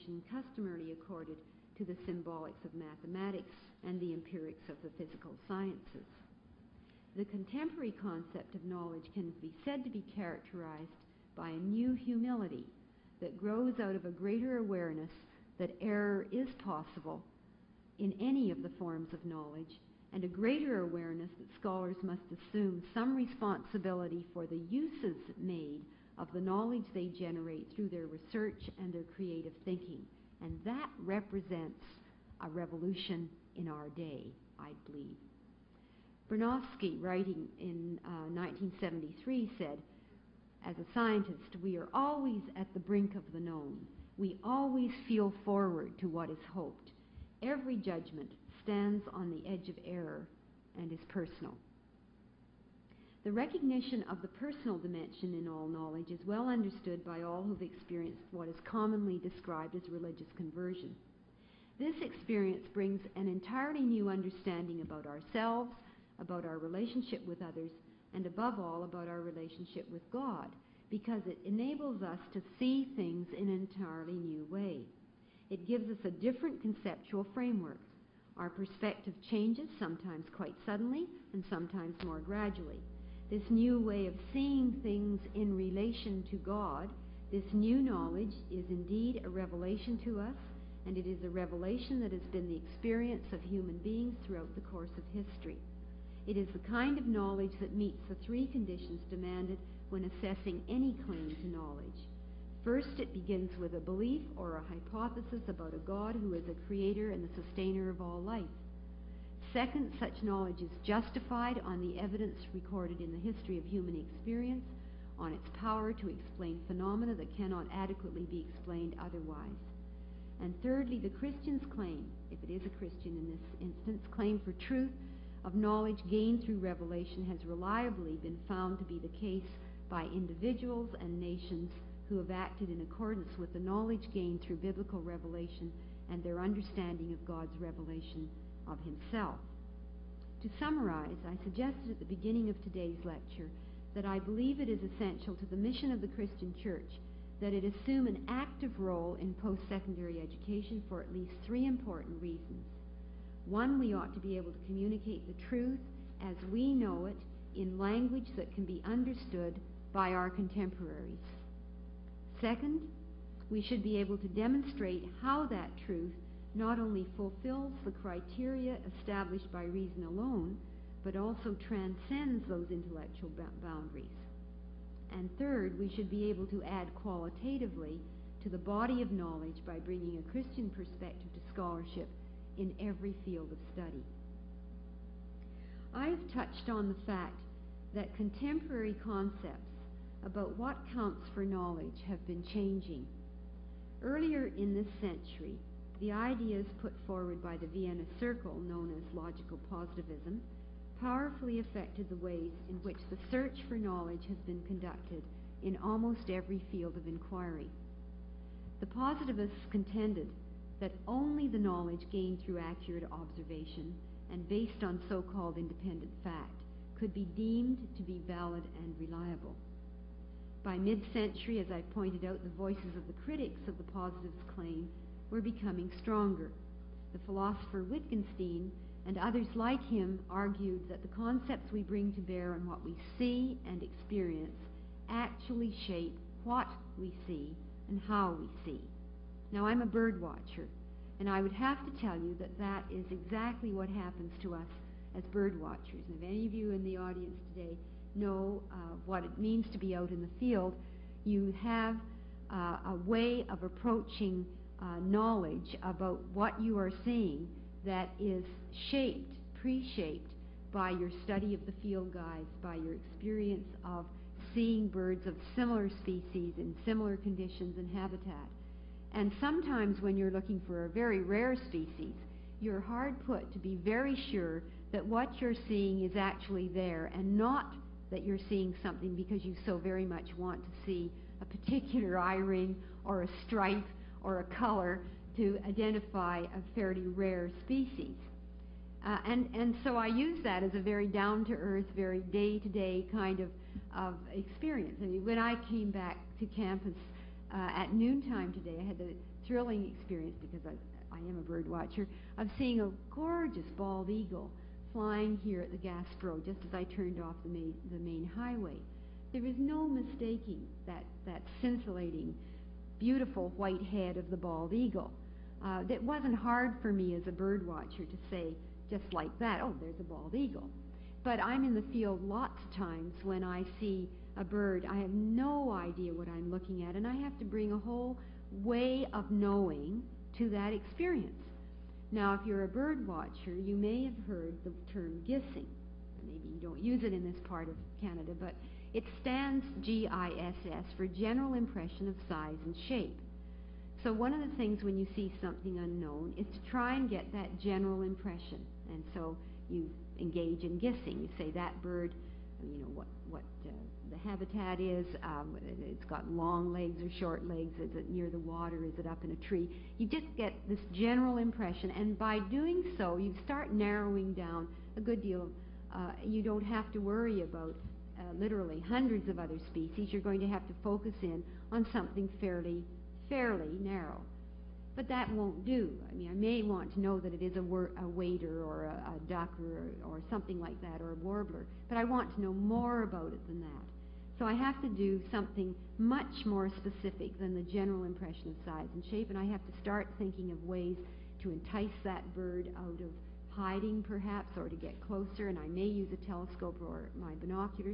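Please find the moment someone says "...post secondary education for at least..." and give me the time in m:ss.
2:29.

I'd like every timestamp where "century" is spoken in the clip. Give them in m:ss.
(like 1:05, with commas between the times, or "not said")
3:14, 3:40.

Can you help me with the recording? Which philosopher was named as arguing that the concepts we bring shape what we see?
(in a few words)
Wittgenstein.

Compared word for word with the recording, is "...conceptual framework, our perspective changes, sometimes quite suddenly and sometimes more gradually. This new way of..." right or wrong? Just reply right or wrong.
right.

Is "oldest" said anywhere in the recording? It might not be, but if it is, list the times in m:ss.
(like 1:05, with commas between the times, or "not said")
not said.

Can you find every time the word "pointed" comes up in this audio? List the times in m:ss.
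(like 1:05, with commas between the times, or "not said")
3:41.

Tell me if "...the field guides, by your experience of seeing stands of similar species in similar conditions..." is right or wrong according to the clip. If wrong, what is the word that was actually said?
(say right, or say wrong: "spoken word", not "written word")
wrong: "birds", not "stands".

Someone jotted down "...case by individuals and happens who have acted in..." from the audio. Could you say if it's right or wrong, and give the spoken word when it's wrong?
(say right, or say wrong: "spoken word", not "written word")
wrong: "nations", not "happens".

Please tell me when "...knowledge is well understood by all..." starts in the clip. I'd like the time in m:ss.
0:55.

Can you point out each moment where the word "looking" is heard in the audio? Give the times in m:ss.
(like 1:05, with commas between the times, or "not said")
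4:30, 5:26.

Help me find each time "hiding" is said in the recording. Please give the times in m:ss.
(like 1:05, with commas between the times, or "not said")
6:33.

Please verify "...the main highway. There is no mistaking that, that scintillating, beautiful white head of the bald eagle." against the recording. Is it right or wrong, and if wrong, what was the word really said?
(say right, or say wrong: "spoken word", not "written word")
right.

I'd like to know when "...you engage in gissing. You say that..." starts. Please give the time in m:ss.
5:49.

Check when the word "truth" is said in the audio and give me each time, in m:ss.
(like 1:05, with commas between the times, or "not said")
2:04, 2:35, 2:45.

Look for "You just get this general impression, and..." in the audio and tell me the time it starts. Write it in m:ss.
5:59.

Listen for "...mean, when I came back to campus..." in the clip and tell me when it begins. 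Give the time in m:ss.
4:55.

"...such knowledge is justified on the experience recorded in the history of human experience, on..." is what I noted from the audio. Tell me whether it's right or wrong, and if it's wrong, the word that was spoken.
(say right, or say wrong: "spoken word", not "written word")
wrong: "evidence", not "experience".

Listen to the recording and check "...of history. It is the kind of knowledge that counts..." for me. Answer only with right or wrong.
wrong.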